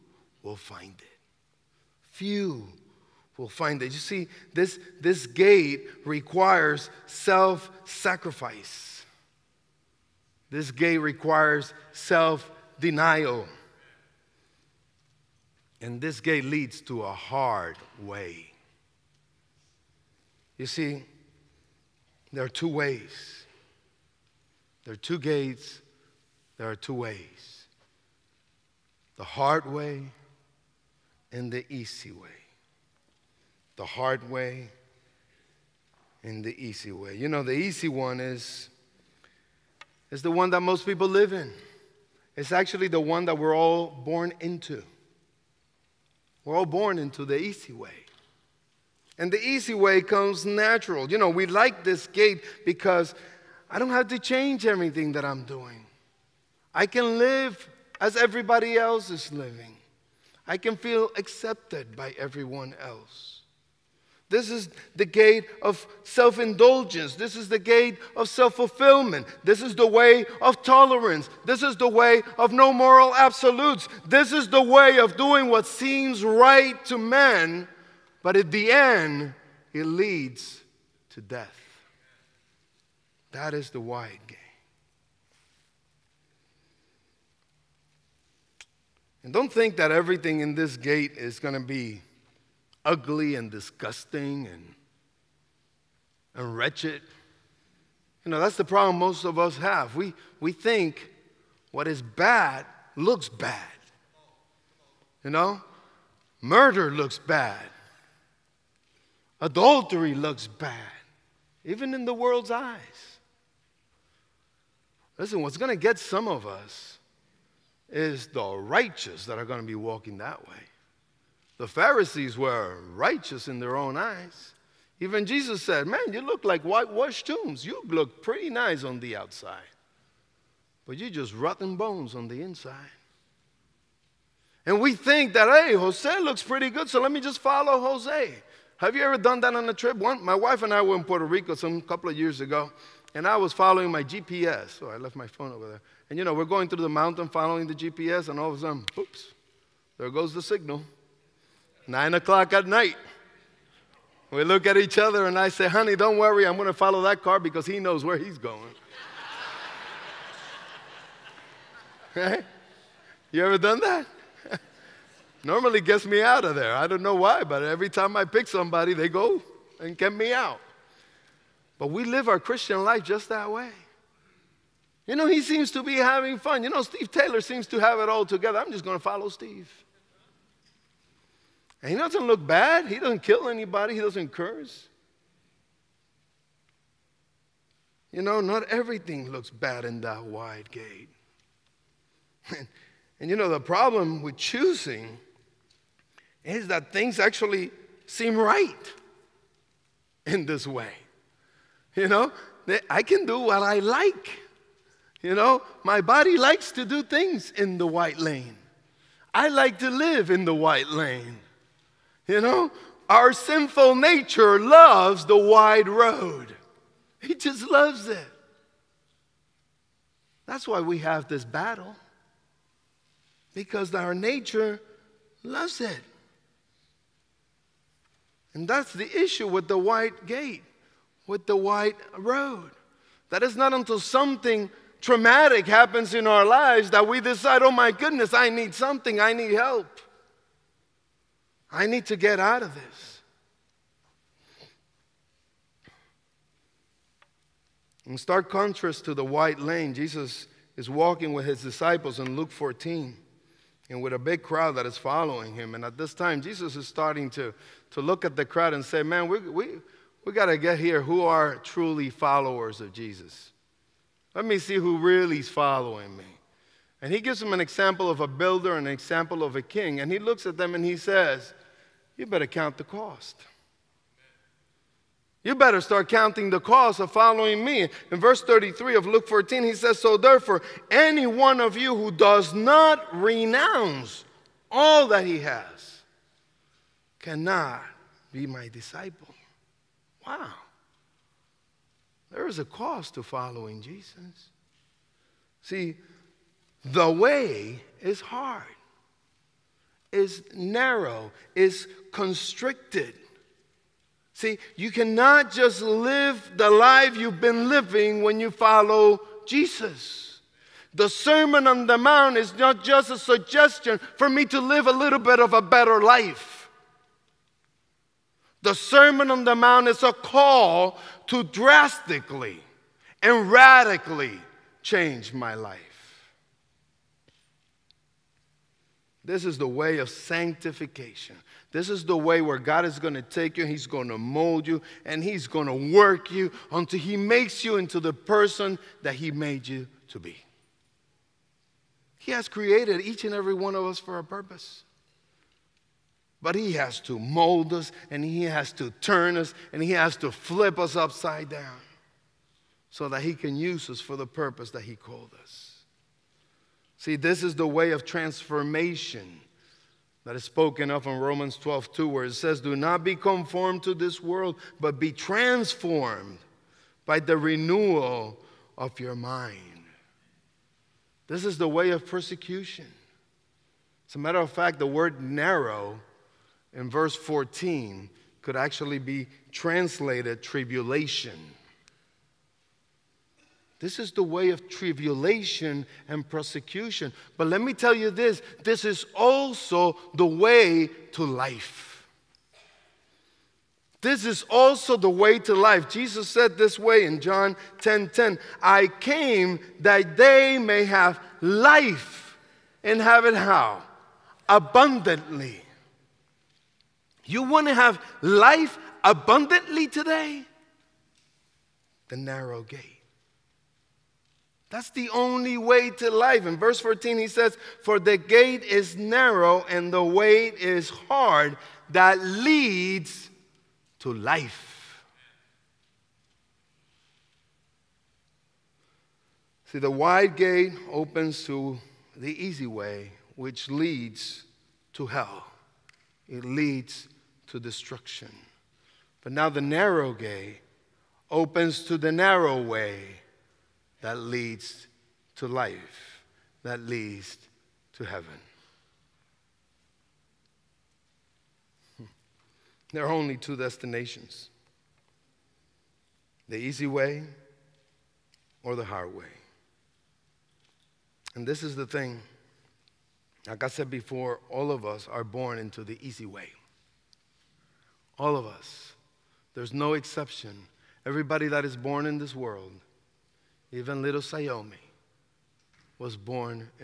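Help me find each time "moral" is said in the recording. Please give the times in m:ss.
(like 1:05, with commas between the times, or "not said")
1:12.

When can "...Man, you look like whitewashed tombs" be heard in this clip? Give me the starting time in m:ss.
2:05.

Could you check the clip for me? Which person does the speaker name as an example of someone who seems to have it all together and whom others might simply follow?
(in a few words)
Steve Taylor.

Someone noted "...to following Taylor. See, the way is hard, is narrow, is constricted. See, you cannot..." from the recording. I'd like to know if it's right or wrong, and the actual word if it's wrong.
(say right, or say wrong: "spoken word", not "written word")
wrong: "Jesus", not "Taylor".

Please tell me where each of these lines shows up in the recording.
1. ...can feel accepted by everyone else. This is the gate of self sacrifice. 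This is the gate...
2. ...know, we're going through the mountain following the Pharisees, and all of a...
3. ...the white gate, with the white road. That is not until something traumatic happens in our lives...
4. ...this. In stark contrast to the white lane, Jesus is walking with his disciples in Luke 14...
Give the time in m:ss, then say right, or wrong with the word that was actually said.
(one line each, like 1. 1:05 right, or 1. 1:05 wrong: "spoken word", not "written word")
1. 1:00 wrong: "indulgence", not "sacrifice"
2. 2:26 wrong: "GPS", not "Pharisees"
3. 3:49 right
4. 4:02 right.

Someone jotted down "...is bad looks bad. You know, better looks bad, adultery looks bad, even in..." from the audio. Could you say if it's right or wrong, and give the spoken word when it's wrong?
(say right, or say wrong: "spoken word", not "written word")
wrong: "murder", not "better".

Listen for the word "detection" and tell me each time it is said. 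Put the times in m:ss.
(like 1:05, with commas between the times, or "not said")
not said.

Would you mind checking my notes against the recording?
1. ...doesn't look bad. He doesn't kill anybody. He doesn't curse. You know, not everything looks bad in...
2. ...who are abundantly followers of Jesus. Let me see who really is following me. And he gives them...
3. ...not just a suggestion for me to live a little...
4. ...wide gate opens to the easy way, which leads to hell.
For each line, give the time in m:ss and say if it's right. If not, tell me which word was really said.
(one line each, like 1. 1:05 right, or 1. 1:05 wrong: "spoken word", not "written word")
1. 3:01 right
2. 4:21 wrong: "truly", not "abundantly"
3. 5:12 right
4. 7:09 right.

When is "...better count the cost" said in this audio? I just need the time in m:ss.
4:32.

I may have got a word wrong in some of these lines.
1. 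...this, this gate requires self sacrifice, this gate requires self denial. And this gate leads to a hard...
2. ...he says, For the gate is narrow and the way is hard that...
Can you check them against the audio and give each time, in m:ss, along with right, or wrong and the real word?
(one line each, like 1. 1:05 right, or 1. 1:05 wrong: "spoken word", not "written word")
1. 0:04 right
2. 6:57 right.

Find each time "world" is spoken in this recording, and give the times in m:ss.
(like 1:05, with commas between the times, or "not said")
1:52, 6:04, 7:52.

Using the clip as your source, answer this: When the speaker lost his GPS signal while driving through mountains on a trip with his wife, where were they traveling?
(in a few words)
Puerto Rico.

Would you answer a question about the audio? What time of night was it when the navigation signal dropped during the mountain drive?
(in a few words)
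9 o'clock.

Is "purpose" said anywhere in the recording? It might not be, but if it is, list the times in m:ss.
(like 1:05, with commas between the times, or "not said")
5:44, 5:54.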